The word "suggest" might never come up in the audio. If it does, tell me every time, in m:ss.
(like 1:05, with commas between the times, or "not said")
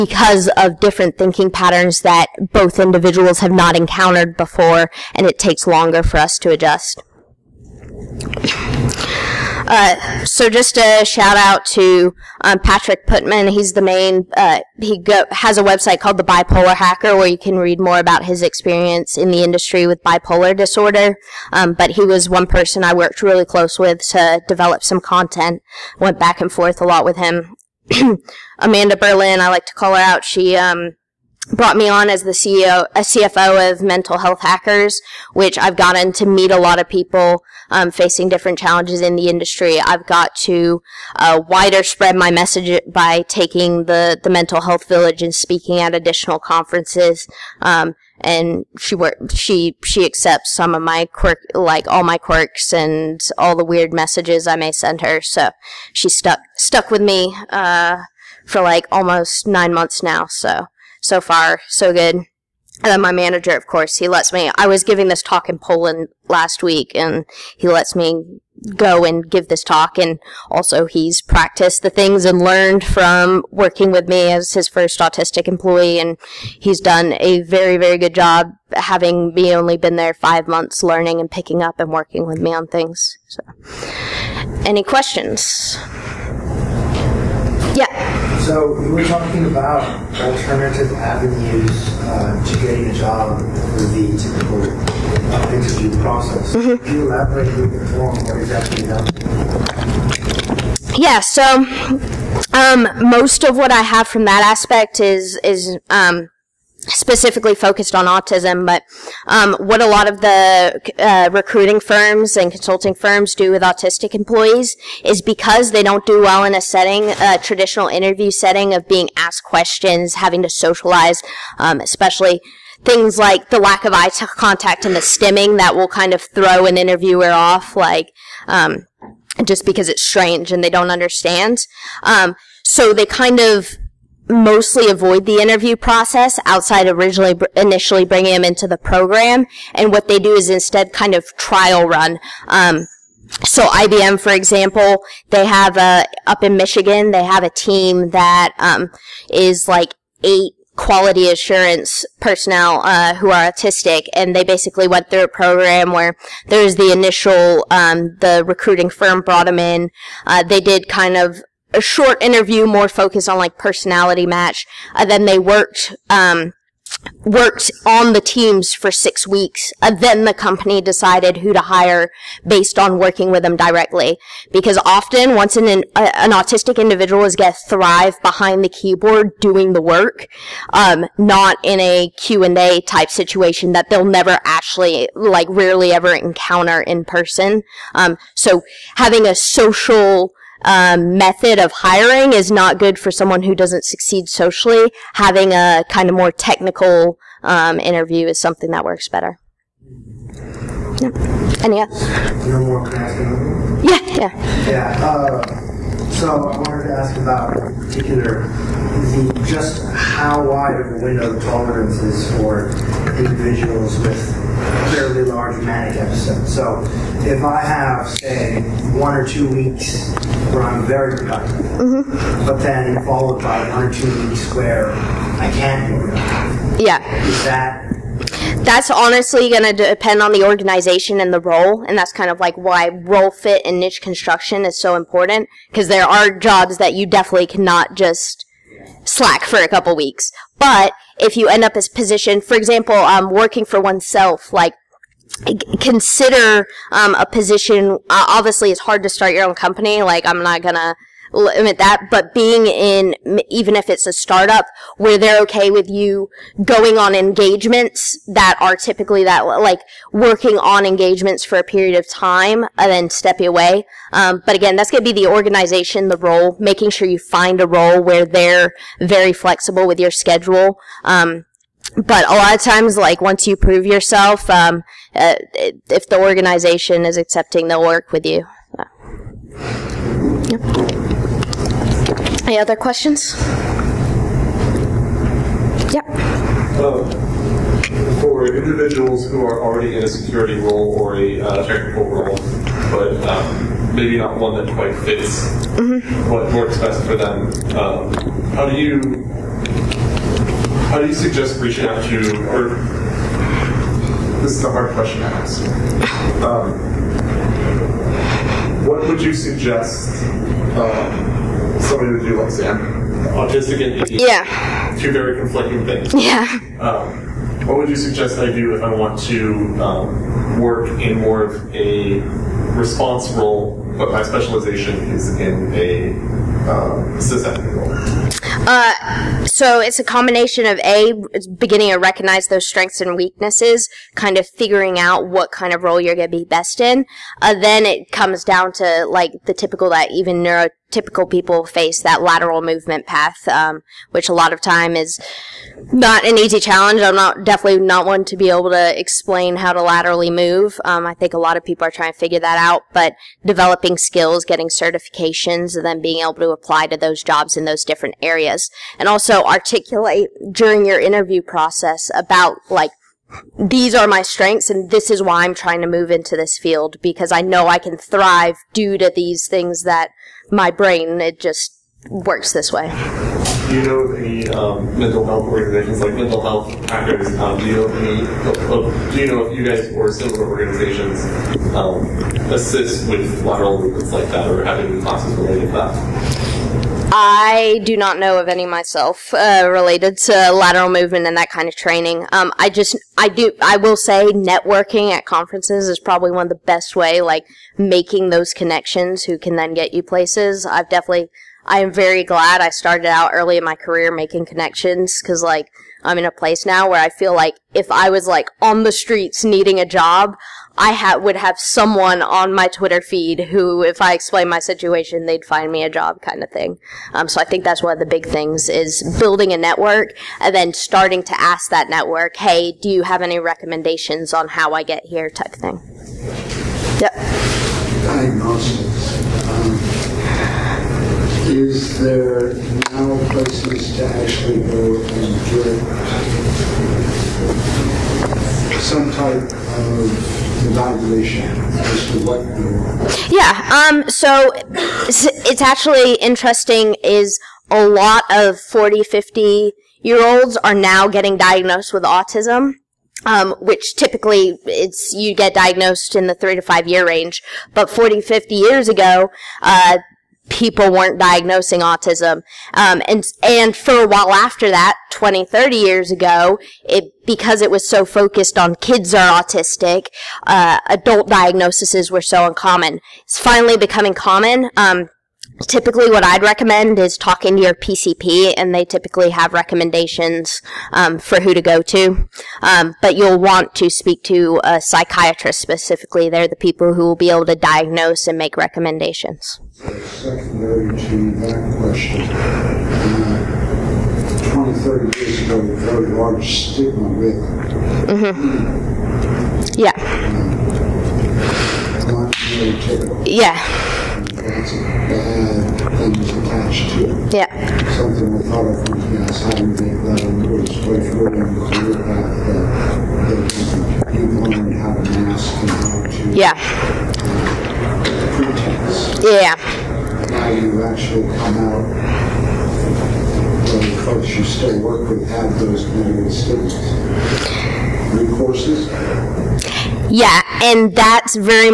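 5:01, 5:09, 5:17.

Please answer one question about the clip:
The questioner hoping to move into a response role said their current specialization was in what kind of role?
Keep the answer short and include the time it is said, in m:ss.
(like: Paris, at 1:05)
sysadmin, at 5:27.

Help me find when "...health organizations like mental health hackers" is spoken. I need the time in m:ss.
6:15.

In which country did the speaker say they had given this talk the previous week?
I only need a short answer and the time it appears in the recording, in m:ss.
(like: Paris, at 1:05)
Poland, at 1:05.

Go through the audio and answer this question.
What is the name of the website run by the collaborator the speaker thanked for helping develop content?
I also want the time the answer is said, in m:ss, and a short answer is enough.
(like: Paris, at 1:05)
The Bipolar Hacker, at 0:16.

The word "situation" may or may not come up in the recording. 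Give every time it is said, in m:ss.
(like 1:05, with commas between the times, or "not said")
3:03, 6:54.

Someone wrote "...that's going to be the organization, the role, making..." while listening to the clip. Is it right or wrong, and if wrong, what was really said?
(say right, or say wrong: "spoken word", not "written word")
right.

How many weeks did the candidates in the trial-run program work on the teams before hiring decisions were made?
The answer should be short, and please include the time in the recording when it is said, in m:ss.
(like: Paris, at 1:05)
6, at 2:48.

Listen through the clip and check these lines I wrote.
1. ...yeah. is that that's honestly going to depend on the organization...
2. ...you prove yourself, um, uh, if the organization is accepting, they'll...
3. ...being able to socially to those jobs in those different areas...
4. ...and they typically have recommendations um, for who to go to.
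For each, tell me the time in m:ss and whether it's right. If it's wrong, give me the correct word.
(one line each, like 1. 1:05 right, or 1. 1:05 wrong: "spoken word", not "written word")
1. 3:46 right
2. 4:33 right
3. 5:55 wrong: "apply", not "socially"
4. 7:58 right.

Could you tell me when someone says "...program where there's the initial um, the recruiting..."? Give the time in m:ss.
2:35.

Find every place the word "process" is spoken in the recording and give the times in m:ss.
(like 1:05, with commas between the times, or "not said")
1:35, 2:15, 6:01.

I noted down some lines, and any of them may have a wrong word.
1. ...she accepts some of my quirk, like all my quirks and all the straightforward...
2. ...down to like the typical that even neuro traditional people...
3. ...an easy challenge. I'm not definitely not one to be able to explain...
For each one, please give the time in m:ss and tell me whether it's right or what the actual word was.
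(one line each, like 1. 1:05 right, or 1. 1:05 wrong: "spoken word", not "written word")
1. 0:49 wrong: "weird", not "straightforward"
2. 5:38 wrong: "typical", not "traditional"
3. 5:46 right.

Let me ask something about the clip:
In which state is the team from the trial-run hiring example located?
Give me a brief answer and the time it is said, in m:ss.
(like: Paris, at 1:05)
Michigan, at 2:26.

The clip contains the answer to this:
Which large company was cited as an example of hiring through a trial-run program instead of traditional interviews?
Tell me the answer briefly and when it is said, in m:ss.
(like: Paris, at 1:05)
IBM, at 2:23.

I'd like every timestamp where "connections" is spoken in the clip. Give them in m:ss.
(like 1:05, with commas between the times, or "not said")
6:38, 6:44.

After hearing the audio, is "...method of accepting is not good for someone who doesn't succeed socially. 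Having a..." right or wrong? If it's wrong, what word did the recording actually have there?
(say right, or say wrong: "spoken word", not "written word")
wrong: "hiring", not "accepting".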